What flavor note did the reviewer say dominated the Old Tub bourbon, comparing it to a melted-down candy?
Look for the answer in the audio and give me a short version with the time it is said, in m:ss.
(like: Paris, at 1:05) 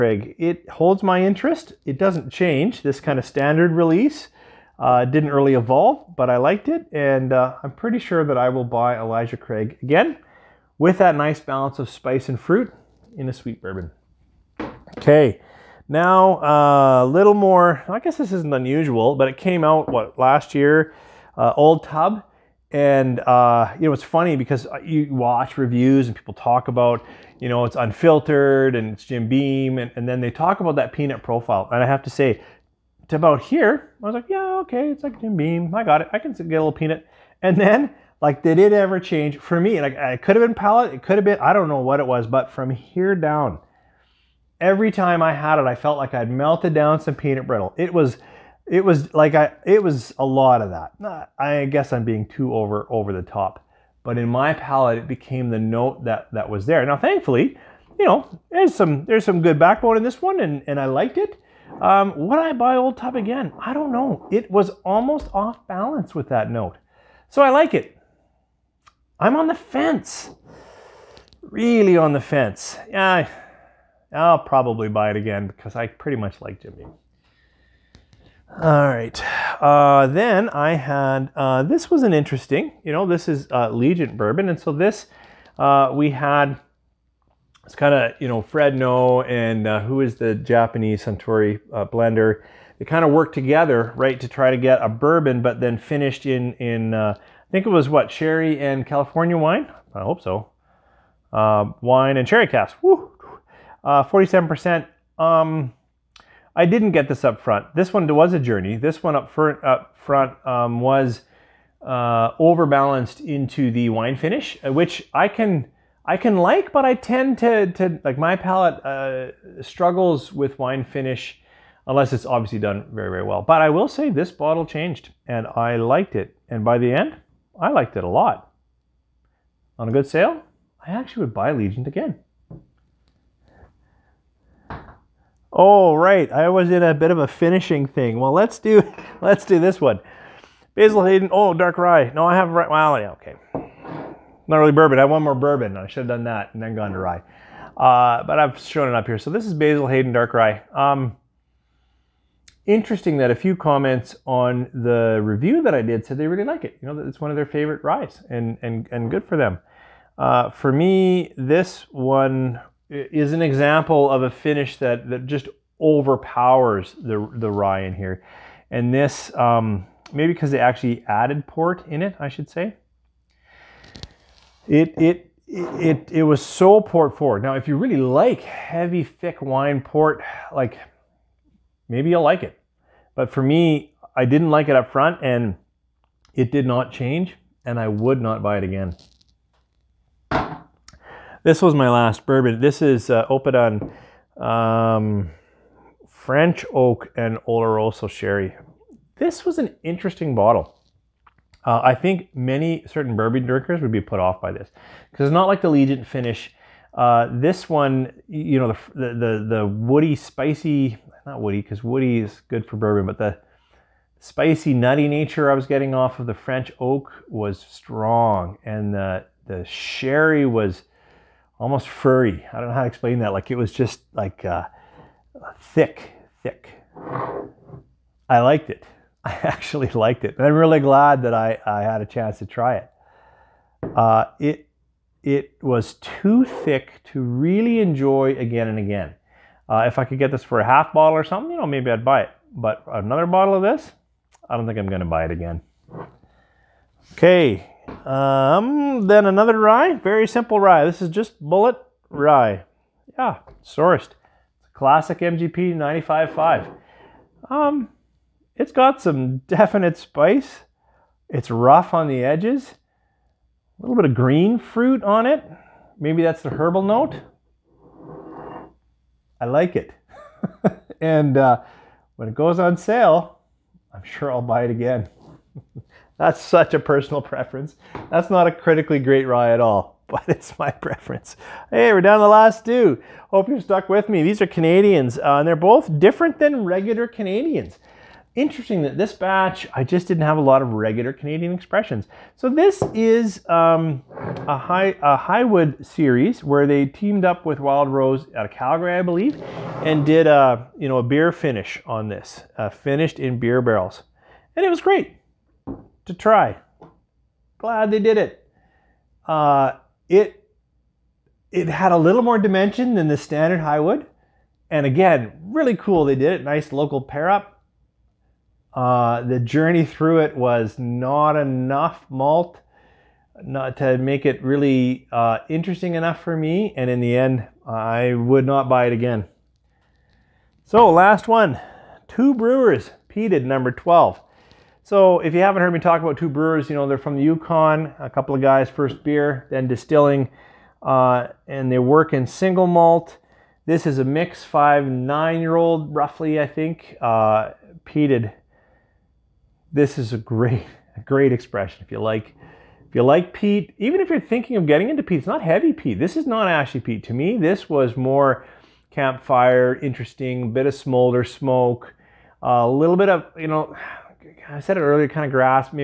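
Peanut brittle, at 0:47.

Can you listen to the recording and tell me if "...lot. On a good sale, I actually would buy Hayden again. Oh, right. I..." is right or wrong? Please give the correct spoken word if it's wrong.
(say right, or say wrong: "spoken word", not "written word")
wrong: "Legent", not "Hayden".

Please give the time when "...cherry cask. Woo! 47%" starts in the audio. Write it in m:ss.
1:42.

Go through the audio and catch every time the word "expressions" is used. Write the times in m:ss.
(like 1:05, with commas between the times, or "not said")
4:51, 5:51.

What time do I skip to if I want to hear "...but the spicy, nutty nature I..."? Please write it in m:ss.
3:33.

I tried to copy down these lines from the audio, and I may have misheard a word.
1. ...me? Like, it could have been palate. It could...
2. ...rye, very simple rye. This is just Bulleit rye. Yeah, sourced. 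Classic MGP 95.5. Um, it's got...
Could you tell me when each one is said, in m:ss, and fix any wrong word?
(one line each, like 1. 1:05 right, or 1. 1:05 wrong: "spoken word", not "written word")
1. 0:39 right
2. 4:09 right.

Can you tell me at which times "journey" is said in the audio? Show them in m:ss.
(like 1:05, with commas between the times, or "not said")
1:48, 5:19.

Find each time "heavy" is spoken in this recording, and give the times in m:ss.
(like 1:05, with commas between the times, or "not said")
2:58, 5:55.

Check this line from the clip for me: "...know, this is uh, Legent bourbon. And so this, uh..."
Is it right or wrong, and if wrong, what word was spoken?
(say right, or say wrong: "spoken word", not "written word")
right.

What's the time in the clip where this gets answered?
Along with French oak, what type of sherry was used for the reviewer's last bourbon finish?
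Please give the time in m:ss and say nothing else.
3:17.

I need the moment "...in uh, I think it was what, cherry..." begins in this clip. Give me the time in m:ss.
1:36.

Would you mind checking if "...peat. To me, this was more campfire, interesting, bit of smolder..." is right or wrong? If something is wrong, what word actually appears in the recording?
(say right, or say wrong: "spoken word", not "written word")
right.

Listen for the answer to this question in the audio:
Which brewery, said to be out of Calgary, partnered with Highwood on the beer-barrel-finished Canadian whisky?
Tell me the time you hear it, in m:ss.
4:57.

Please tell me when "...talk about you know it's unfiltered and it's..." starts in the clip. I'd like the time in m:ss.
0:26.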